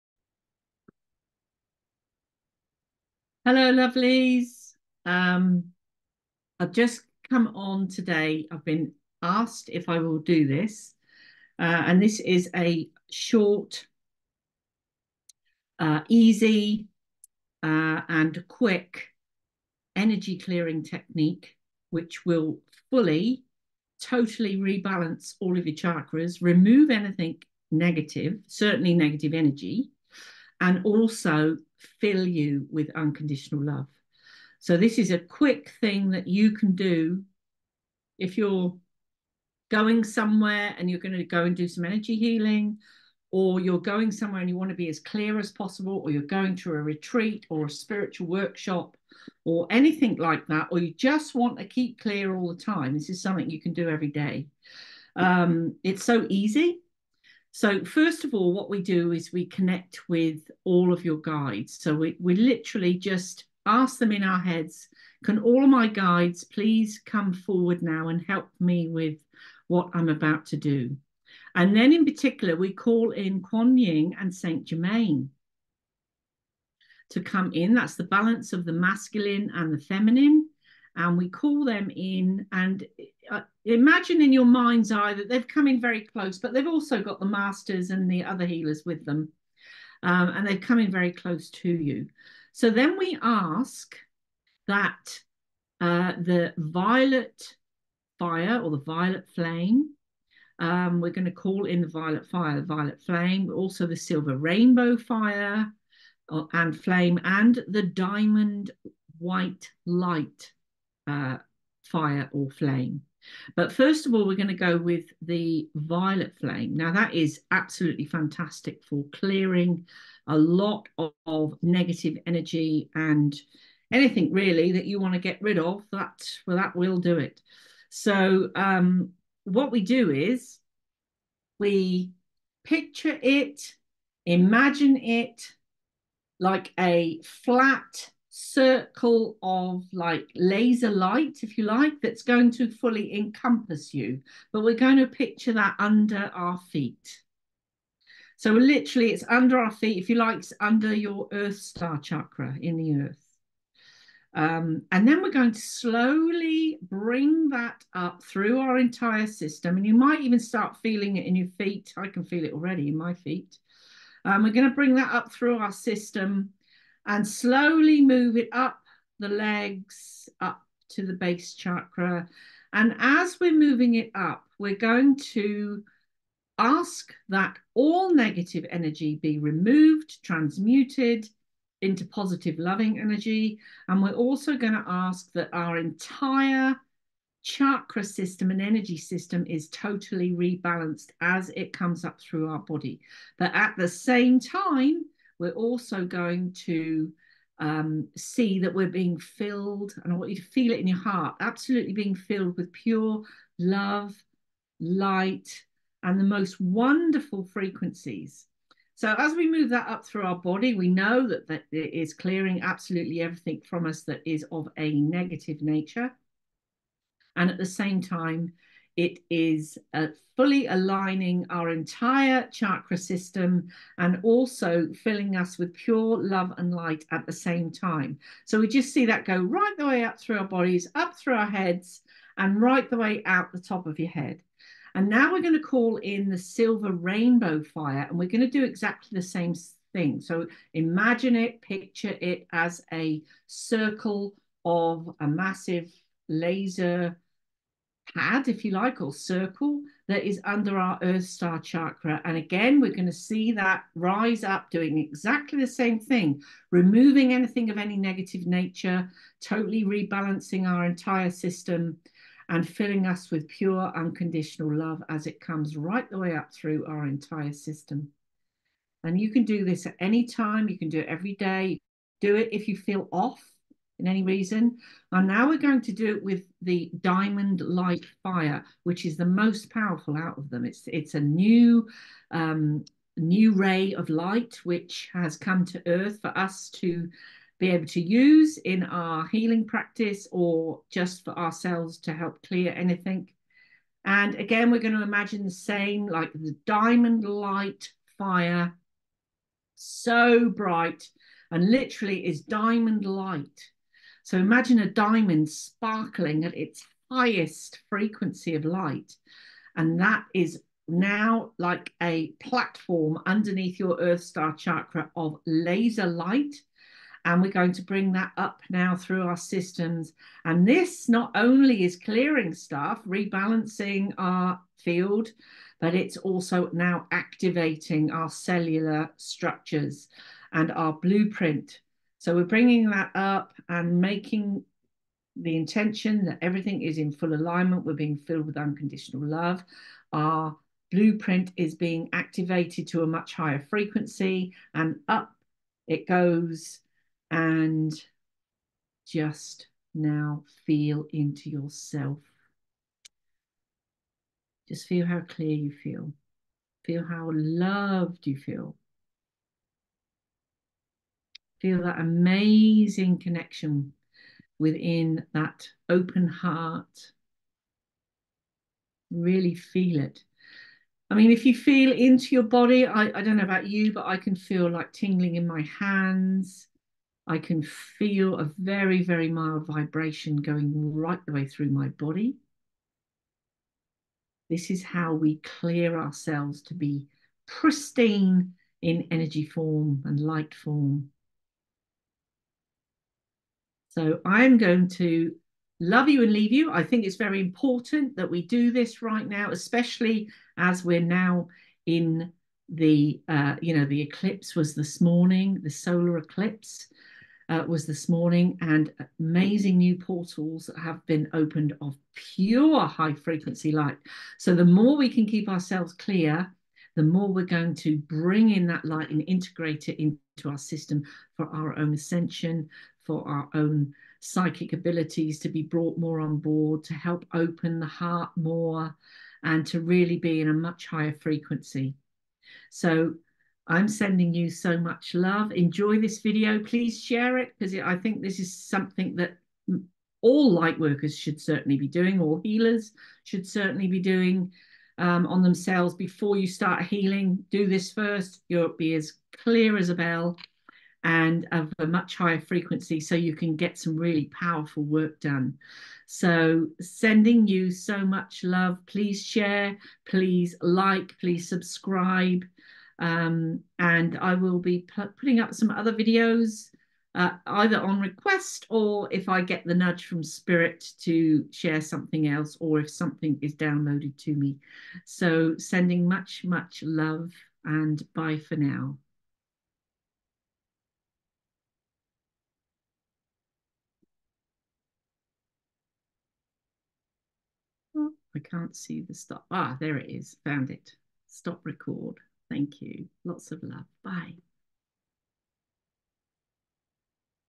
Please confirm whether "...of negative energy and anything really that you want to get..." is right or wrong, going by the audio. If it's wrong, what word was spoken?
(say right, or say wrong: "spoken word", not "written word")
right.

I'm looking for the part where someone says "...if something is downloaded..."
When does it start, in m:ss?
7:52.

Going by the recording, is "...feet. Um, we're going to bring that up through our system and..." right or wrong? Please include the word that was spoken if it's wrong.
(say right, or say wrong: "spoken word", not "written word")
right.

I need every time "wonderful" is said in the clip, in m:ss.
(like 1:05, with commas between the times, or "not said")
3:26.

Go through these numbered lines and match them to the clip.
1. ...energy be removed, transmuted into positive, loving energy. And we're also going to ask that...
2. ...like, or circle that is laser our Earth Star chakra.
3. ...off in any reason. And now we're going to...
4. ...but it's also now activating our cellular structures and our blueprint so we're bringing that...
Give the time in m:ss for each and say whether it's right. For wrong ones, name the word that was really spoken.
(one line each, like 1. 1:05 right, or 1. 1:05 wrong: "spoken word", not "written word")
1. 2:58 right
2. 4:08 wrong: "under", not "laser"
3. 4:33 right
4. 5:25 right.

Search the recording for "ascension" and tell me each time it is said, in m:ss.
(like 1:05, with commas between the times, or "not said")
7:01.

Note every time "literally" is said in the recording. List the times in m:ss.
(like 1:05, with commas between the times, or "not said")
1:02, 2:28, 5:01.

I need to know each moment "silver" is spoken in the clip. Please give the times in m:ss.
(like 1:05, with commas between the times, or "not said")
1:43, 3:56.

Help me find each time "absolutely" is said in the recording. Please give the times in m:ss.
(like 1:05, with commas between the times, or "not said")
1:57, 3:21, 3:32.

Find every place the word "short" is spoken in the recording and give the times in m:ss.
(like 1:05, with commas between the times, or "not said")
0:13.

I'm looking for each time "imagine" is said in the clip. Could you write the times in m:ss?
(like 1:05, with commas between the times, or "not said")
1:23, 2:14, 4:00, 4:55, 5:04.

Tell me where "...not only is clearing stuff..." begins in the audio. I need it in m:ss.
5:21.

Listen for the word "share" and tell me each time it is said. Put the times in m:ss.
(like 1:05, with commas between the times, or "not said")
7:17, 7:39, 7:51.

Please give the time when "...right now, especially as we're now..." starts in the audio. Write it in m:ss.
6:39.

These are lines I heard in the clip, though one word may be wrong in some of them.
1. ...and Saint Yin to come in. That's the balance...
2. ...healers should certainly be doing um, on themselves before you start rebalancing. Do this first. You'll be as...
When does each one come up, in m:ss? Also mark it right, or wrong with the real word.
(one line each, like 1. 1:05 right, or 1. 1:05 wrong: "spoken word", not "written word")
1. 1:14 wrong: "Germain", not "Yin"
2. 7:22 wrong: "healing", not "rebalancing".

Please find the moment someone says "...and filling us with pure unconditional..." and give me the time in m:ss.
4:22.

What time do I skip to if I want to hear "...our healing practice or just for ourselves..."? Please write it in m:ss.
4:48.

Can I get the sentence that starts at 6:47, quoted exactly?
Uh, was this morning, and amazing new portals have been opened of pure high frequency light.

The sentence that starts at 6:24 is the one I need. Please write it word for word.
This is how we clear ourselves to be pristine in energy form and light form.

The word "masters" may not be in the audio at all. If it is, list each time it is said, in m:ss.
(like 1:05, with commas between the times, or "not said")
1:27.